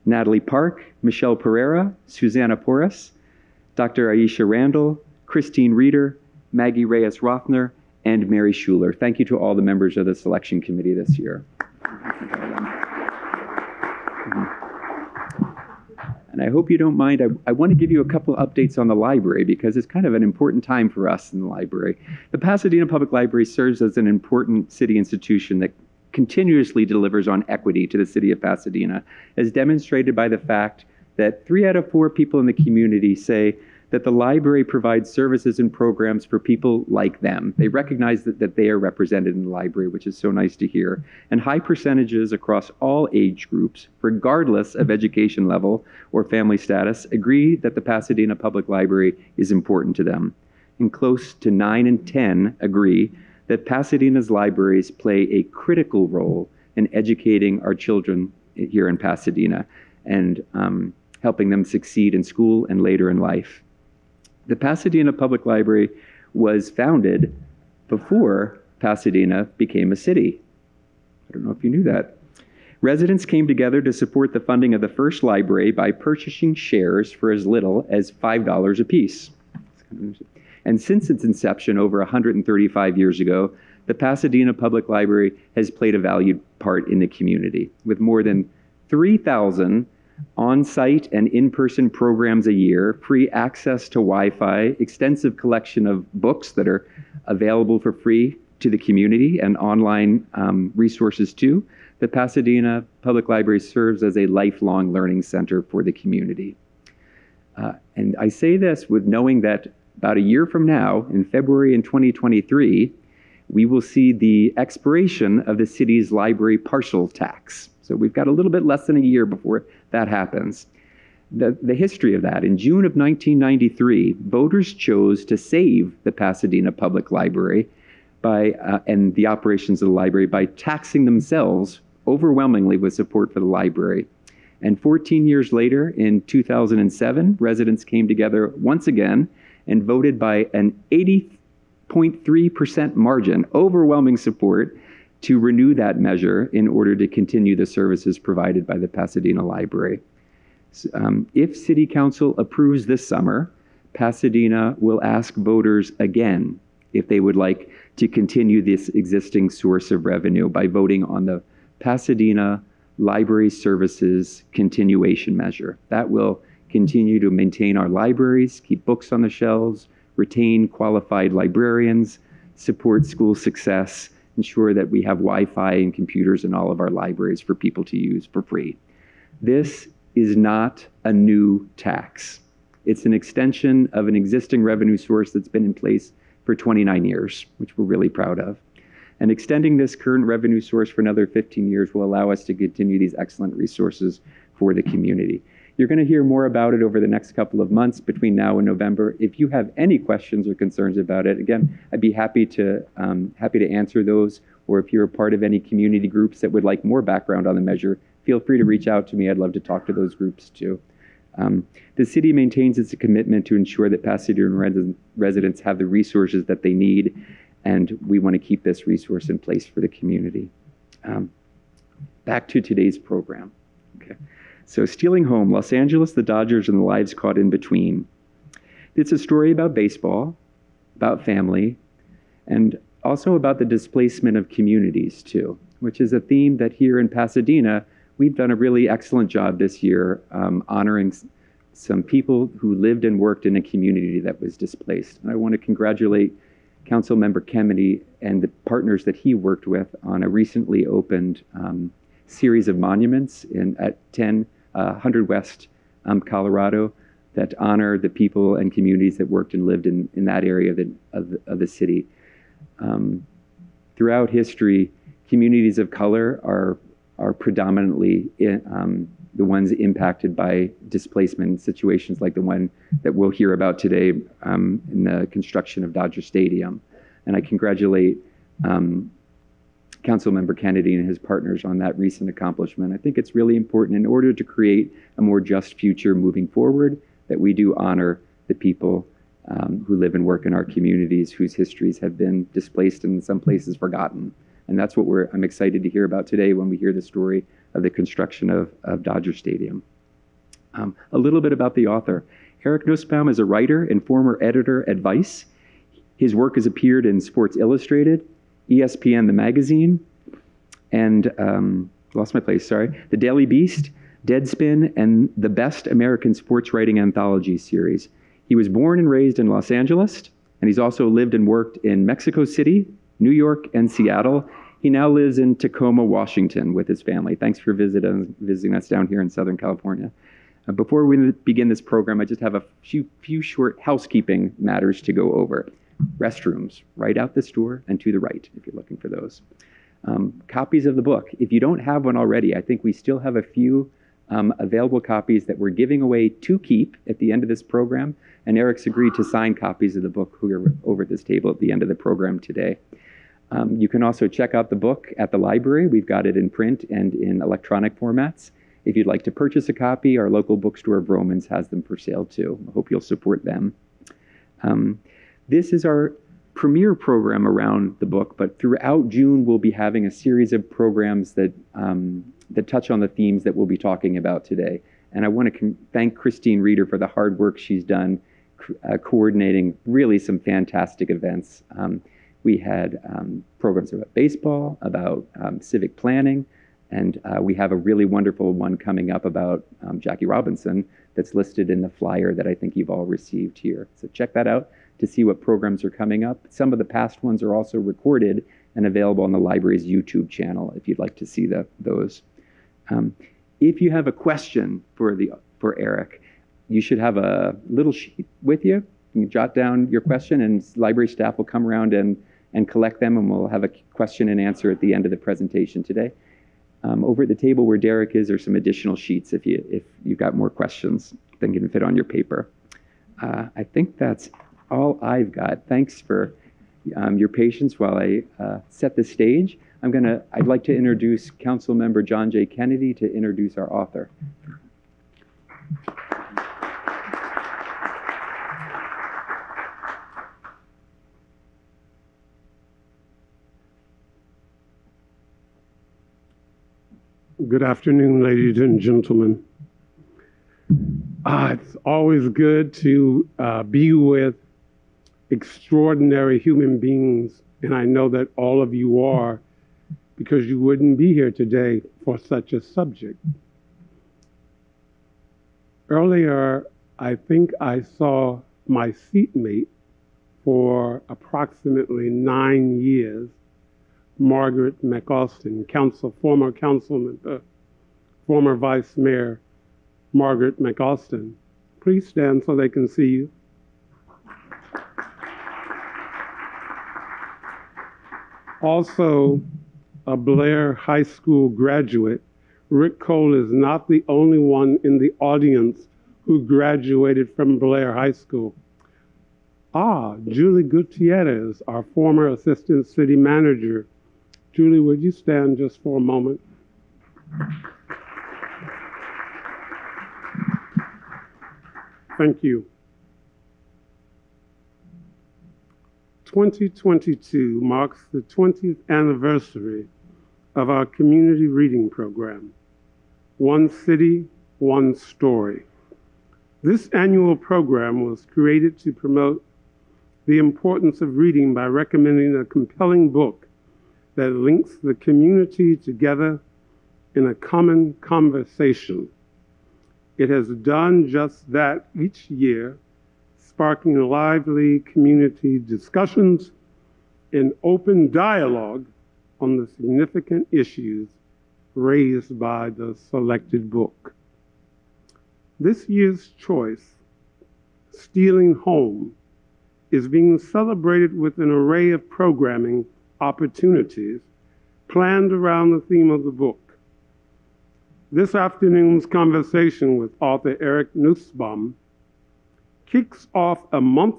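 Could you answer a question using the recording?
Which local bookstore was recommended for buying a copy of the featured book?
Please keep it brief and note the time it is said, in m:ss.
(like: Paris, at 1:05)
Vroman's, at 6:01.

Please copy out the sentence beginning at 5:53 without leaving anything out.
Um, you can also check out the book at the library.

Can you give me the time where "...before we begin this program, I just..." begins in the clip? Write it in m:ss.
5:30.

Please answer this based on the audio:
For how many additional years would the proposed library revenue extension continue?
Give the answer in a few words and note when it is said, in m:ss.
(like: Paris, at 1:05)
15 years, at 3:11.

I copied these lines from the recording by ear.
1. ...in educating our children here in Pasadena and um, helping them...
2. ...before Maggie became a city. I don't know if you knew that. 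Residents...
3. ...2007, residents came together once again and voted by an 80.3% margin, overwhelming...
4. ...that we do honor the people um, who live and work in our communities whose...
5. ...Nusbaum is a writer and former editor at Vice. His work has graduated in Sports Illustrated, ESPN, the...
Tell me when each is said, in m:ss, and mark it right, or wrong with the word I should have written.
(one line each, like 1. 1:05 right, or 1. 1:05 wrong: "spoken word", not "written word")
1. 0:56 right
2. 1:07 wrong: "Pasadena", not "Maggie"
3. 2:16 right
4. 4:47 right
5. 5:02 wrong: "appeared", not "graduated".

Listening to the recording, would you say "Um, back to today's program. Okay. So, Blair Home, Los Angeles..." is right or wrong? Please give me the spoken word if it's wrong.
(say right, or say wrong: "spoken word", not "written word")
wrong: "Stealing", not "Blair".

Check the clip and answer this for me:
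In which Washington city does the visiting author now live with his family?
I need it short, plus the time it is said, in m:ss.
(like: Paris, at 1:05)
Tacoma, at 5:25.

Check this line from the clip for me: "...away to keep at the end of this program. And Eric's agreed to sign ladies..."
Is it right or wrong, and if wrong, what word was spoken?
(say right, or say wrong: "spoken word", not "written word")
wrong: "copies", not "ladies".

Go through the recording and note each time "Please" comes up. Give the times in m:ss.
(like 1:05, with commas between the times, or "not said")
8:01.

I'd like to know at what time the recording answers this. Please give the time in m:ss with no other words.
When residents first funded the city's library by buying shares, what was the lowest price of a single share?
1:18.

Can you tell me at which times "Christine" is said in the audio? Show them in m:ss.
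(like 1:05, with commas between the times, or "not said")
0:05, 6:16.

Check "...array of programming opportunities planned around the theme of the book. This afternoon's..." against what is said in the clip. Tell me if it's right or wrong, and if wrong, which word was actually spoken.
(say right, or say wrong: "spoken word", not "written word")
right.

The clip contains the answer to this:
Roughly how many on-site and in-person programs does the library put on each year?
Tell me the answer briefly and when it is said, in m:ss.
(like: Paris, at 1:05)
3,000, at 1:28.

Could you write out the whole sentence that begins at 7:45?
Earlier, I think I saw my seatmate for approximately nine years, Margaret McAustin, council, former councilman, uh, former vice mayor, Margaret McAustin.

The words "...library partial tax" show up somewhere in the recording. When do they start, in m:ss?
1:56.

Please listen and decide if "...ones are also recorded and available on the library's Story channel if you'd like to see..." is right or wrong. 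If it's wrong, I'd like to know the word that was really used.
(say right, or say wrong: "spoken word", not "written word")
wrong: "YouTube", not "Story".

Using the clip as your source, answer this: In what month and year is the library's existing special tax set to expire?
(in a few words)
February 2023.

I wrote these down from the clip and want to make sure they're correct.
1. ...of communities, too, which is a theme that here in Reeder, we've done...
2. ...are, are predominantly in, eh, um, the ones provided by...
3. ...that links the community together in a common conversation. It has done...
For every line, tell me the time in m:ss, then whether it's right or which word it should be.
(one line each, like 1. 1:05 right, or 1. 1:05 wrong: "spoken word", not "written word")
1. 3:54 wrong: "Pasadena", not "Reeder"
2. 4:26 wrong: "impacted", not "provided"
3. 8:54 right.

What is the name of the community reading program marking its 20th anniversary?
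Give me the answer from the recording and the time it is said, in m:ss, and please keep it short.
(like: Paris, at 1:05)
One City, One Story, at 8:43.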